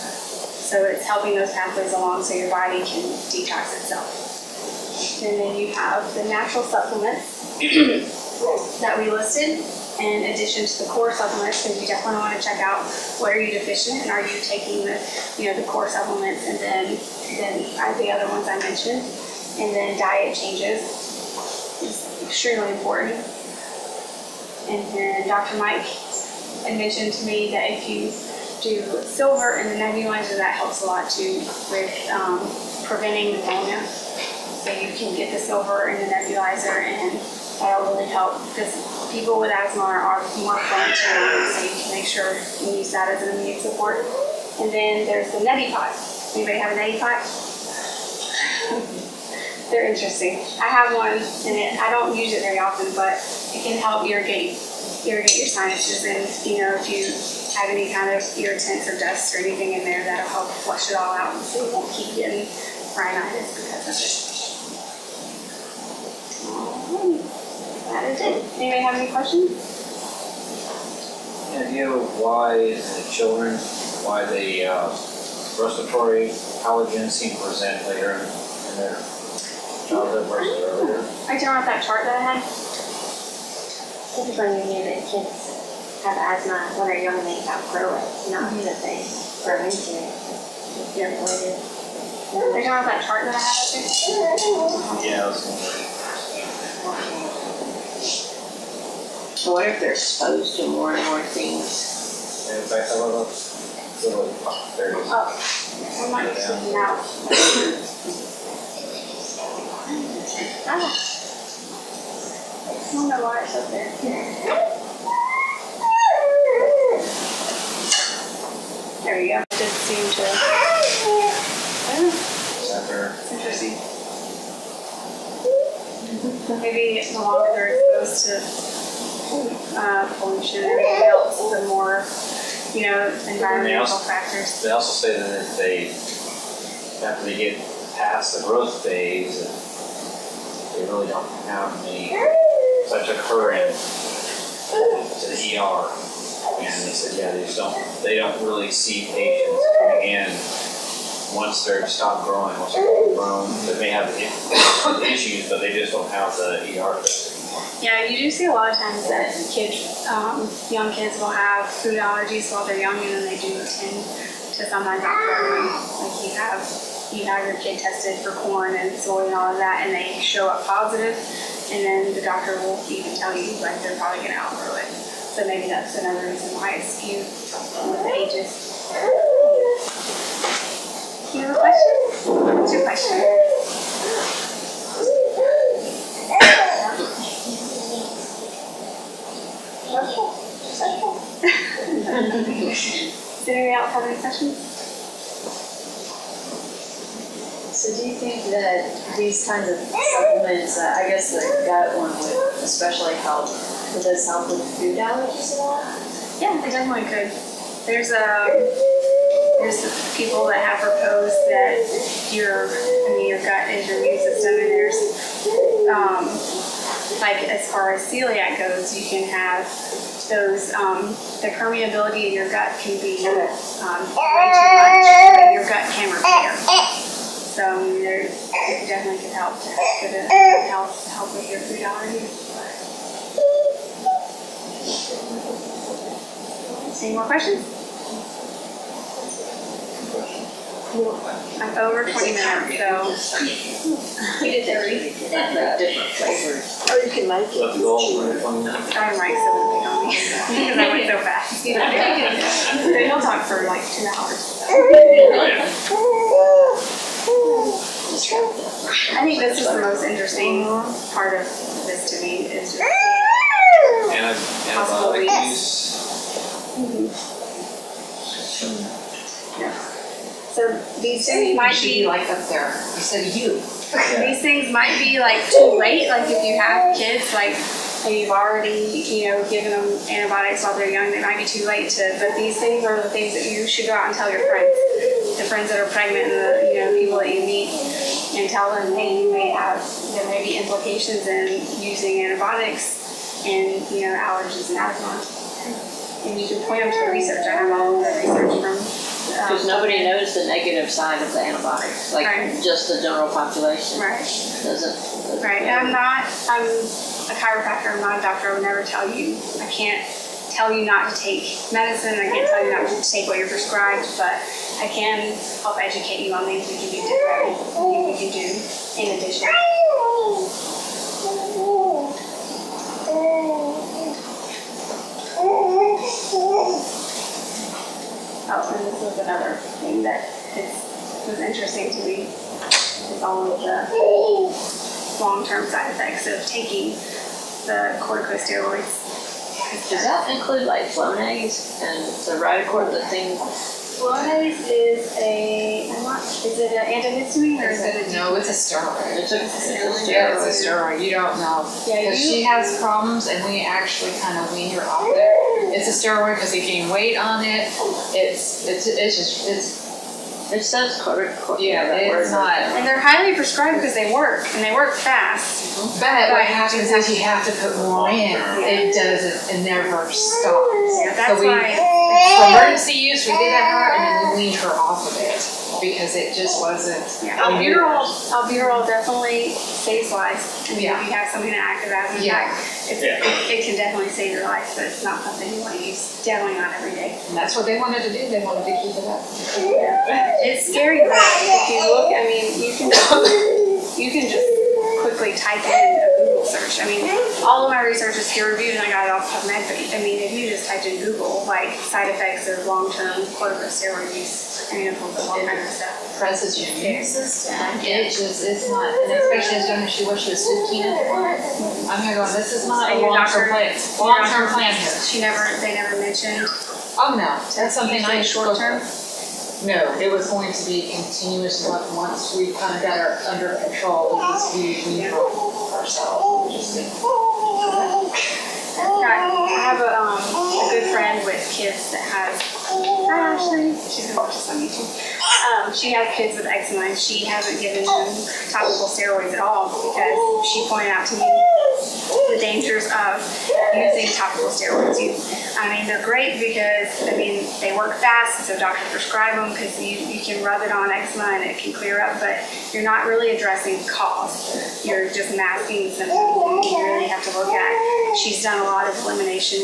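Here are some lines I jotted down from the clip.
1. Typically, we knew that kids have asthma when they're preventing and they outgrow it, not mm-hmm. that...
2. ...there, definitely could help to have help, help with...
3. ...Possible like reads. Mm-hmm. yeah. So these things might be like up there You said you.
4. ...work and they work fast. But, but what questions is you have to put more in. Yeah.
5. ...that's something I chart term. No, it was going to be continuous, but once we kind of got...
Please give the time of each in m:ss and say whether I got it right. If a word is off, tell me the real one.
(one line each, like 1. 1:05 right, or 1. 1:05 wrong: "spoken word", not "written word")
1. 1:24 wrong: "young", not "preventing"
2. 3:47 right
3. 4:24 right
4. 6:04 wrong: "happens", not "questions"
5. 6:57 wrong: "short", not "chart".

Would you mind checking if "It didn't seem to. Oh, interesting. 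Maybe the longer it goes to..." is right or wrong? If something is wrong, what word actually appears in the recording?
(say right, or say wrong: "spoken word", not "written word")
right.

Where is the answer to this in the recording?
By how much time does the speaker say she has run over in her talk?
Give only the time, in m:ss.
4:02.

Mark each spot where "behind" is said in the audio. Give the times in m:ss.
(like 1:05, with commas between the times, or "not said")
not said.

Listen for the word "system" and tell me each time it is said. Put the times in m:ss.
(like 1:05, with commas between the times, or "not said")
3:34, 6:47.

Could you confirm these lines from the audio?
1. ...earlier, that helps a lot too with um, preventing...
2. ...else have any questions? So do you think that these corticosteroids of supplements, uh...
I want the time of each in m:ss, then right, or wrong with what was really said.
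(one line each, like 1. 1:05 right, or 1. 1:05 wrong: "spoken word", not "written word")
1. 0:29 wrong: "nebulizer", not "earlier"
2. 3:13 wrong: "kinds", not "corticosteroids".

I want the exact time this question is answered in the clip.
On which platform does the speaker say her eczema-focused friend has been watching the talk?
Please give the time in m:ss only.
7:14.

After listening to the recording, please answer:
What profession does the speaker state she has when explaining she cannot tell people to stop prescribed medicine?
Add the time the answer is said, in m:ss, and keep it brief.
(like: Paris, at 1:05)
Chiropractor, at 5:07.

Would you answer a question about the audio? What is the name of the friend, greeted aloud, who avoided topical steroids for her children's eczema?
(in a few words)
Ashley.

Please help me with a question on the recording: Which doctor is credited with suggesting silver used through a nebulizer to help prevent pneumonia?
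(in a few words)
Dr. Mike.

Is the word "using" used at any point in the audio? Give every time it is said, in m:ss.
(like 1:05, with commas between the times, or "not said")
4:51, 7:23.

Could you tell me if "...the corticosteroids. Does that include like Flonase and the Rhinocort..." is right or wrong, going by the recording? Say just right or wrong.
right.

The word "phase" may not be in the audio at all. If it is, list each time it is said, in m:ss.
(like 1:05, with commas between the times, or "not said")
2:18.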